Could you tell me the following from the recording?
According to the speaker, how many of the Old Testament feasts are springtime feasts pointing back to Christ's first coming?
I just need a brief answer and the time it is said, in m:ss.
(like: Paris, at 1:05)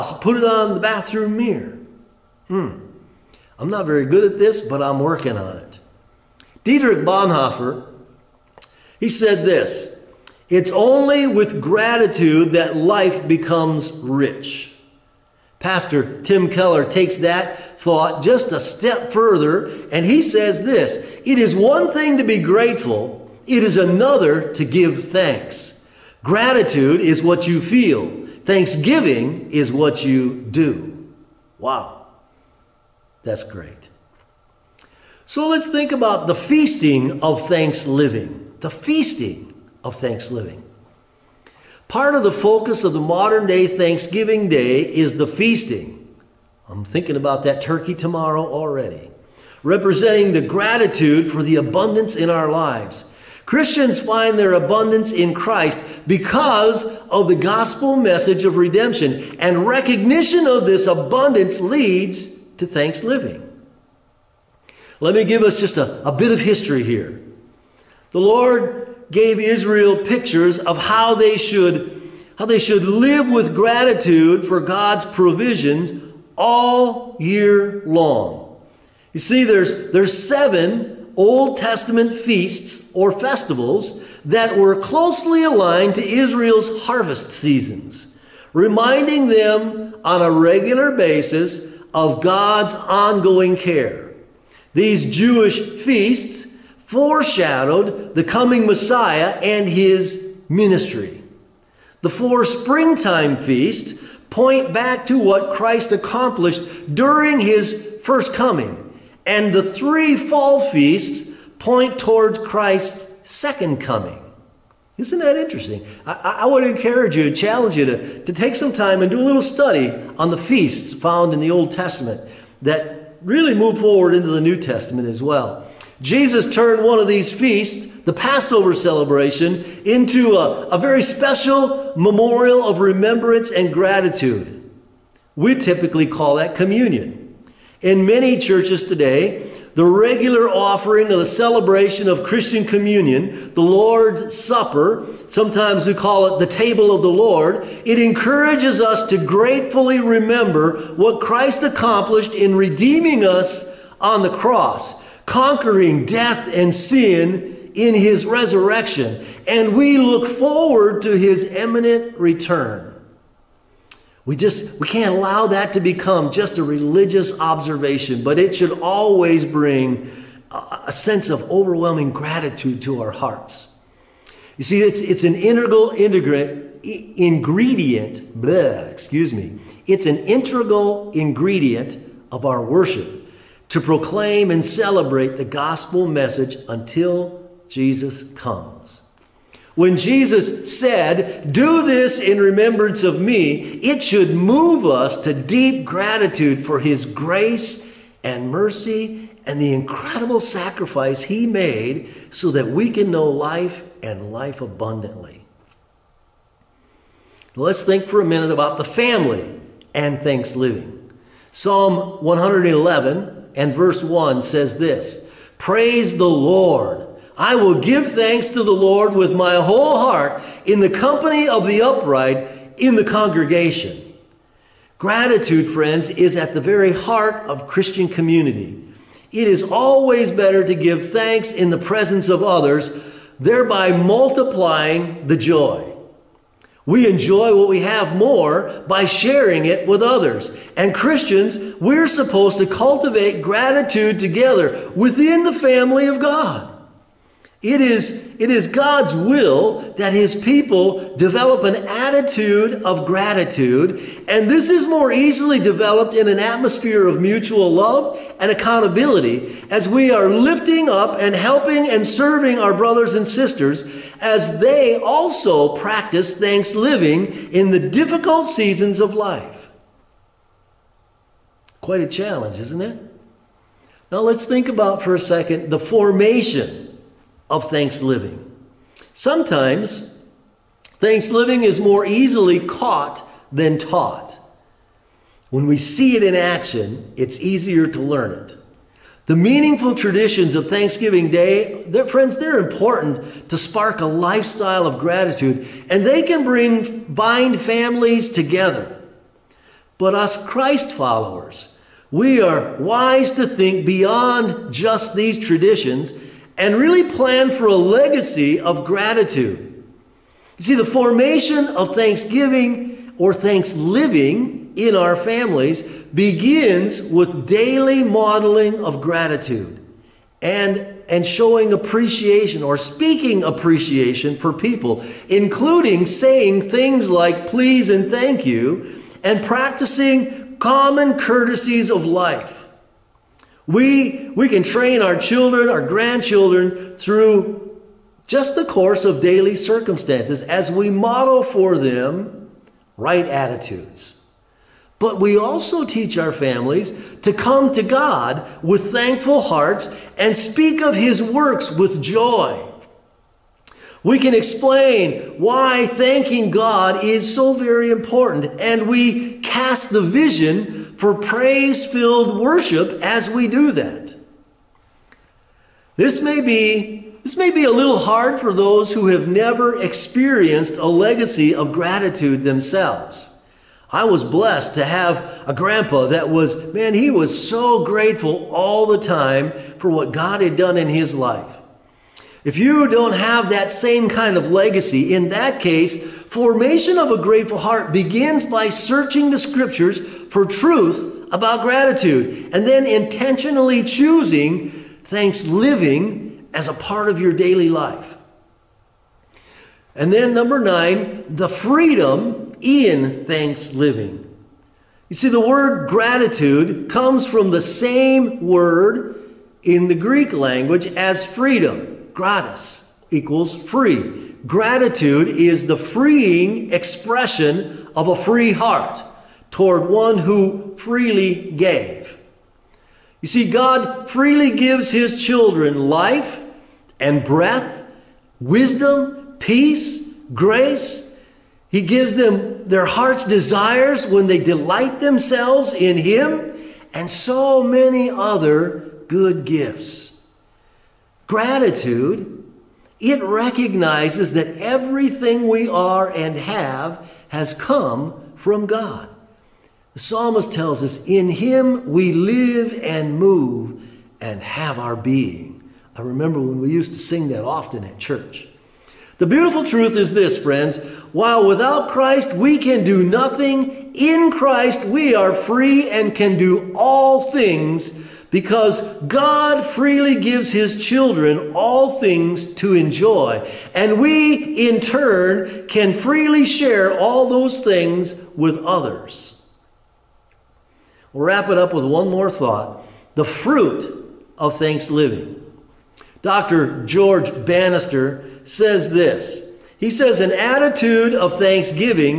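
4, at 1:42.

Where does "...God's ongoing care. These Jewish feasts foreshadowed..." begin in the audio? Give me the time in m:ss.
1:32.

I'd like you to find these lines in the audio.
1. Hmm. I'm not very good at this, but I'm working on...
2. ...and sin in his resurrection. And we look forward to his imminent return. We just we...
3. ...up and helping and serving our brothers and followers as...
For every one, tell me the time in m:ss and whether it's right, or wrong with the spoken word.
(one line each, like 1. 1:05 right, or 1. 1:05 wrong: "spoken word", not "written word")
1. 0:02 right
2. 2:36 right
3. 4:20 wrong: "sisters", not "followers".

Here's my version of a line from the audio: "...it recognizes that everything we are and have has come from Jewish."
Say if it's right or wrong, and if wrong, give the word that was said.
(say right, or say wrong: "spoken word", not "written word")
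wrong: "God", not "Jewish".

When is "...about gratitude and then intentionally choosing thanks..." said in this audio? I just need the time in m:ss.
6:31.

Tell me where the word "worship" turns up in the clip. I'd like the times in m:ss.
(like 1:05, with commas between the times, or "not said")
3:02, 6:02.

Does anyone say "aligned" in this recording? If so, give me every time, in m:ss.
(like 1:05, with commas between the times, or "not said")
1:25.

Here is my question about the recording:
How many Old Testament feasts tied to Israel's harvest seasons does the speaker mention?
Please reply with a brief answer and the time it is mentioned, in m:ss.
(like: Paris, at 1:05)
7, at 1:20.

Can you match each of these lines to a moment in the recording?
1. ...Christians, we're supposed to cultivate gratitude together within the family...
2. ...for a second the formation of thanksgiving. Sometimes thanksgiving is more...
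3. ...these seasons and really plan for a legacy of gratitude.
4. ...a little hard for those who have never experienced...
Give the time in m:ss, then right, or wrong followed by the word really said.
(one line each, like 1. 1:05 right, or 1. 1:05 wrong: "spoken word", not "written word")
1. 4:00 right
2. 4:34 right
3. 5:05 wrong: "traditions", not "seasons"
4. 6:07 right.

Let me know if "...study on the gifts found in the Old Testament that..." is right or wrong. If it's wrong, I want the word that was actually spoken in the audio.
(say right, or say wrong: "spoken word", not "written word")
wrong: "feasts", not "gifts".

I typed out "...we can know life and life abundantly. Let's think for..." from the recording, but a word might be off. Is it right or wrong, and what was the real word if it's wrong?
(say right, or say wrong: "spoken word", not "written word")
right.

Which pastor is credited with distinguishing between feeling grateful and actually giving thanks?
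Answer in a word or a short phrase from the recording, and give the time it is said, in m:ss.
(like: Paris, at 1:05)
Tim Keller, at 0:16.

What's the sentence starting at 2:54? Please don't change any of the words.
You see, it's it's an integral integrant ingredient.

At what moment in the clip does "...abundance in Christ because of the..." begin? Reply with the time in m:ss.
0:54.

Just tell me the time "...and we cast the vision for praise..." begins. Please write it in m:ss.
5:58.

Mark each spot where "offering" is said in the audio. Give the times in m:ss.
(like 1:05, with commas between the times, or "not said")
2:20.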